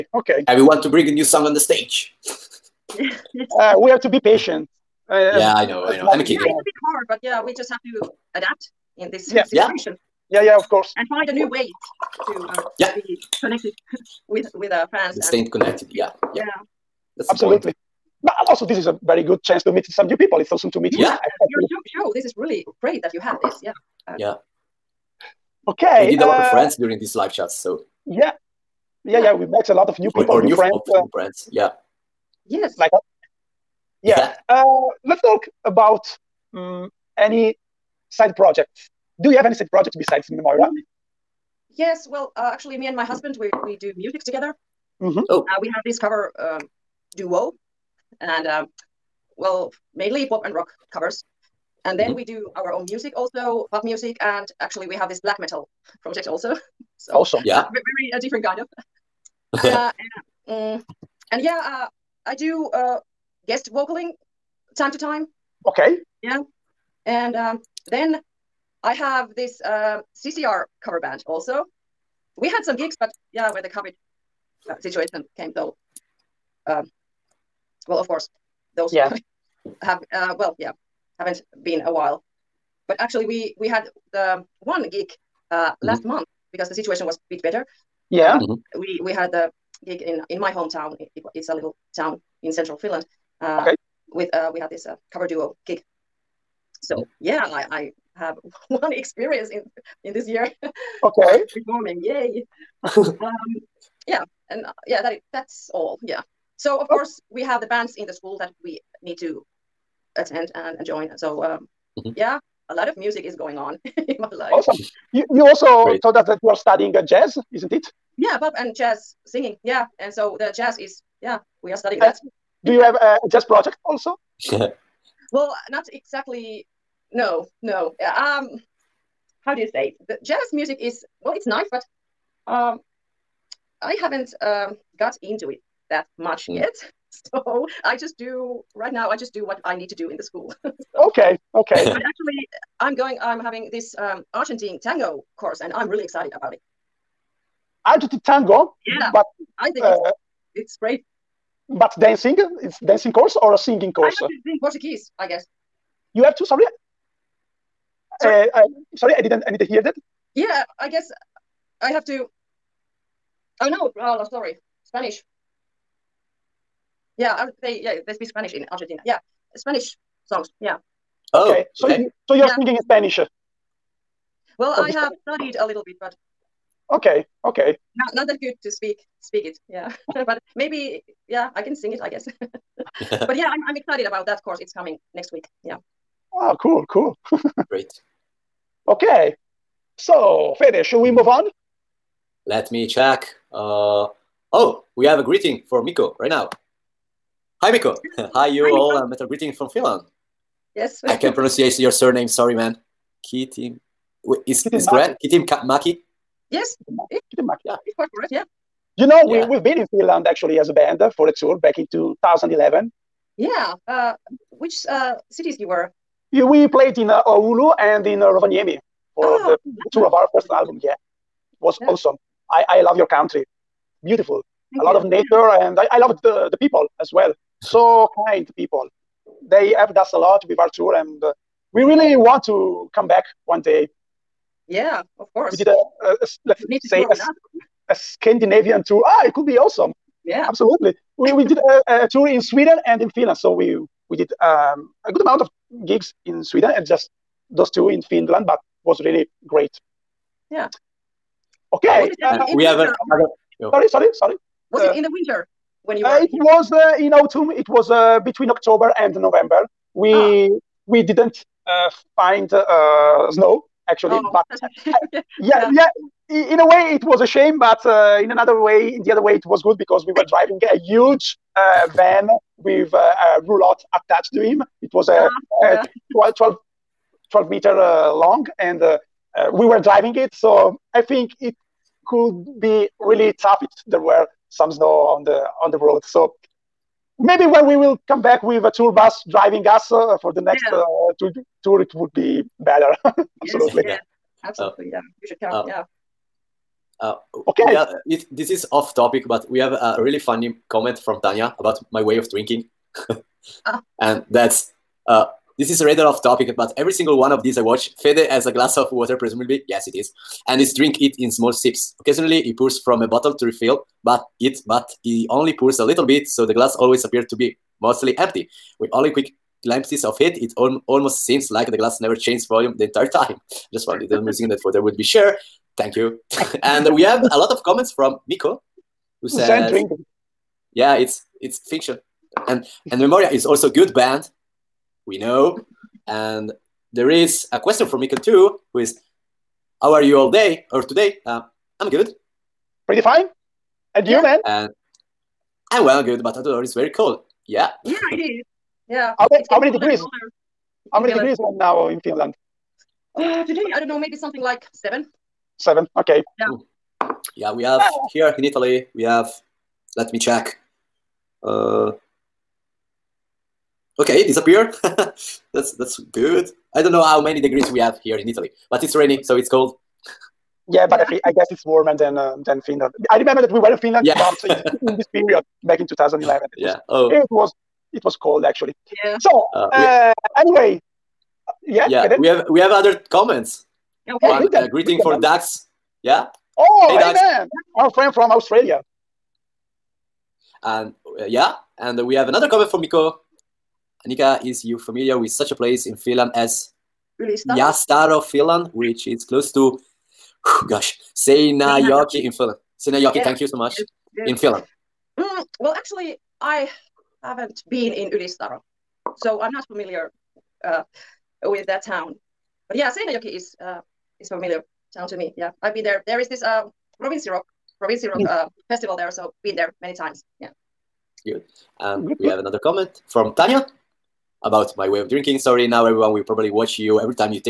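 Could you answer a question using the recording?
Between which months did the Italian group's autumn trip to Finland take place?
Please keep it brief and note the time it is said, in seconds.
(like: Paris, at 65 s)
October and November, at 258 s.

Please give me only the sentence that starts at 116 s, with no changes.
told us that you are studying uh, jazz, isn't it?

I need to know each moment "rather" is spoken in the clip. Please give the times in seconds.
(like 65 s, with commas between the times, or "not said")
305 s.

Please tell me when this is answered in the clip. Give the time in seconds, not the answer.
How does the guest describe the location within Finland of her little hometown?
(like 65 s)
92 s.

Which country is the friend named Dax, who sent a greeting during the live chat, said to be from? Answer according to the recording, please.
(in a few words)
Australia.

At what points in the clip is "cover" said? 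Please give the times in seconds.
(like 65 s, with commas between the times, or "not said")
45 s, 50 s, 70 s, 95 s.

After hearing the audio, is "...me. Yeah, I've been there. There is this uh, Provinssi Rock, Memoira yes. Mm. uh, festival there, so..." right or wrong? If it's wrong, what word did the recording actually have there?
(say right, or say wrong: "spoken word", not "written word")
wrong: "Rock", not "Memoira".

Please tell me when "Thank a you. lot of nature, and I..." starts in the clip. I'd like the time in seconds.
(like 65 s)
224 s.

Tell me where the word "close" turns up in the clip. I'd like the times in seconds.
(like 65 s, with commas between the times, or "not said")
399 s.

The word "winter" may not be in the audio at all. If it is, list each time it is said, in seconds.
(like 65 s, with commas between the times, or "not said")
255 s.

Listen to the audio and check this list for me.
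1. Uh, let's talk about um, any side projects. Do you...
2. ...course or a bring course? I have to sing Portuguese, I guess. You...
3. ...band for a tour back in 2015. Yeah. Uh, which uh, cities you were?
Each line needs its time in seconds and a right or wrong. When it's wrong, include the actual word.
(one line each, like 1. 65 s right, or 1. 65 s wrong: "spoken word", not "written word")
1. 34 s right
2. 153 s wrong: "singing", not "bring"
3. 210 s wrong: "2011", not "2015".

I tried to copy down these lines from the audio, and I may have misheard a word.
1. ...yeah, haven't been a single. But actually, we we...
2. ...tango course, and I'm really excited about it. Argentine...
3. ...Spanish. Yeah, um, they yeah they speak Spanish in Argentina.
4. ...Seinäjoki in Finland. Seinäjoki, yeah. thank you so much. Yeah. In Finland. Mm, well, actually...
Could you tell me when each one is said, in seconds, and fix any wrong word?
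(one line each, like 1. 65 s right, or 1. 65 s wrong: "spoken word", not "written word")
1. 80 s wrong: "while", not "single"
2. 144 s right
3. 164 s right
4. 401 s right.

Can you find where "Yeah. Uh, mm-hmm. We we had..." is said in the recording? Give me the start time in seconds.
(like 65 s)
88 s.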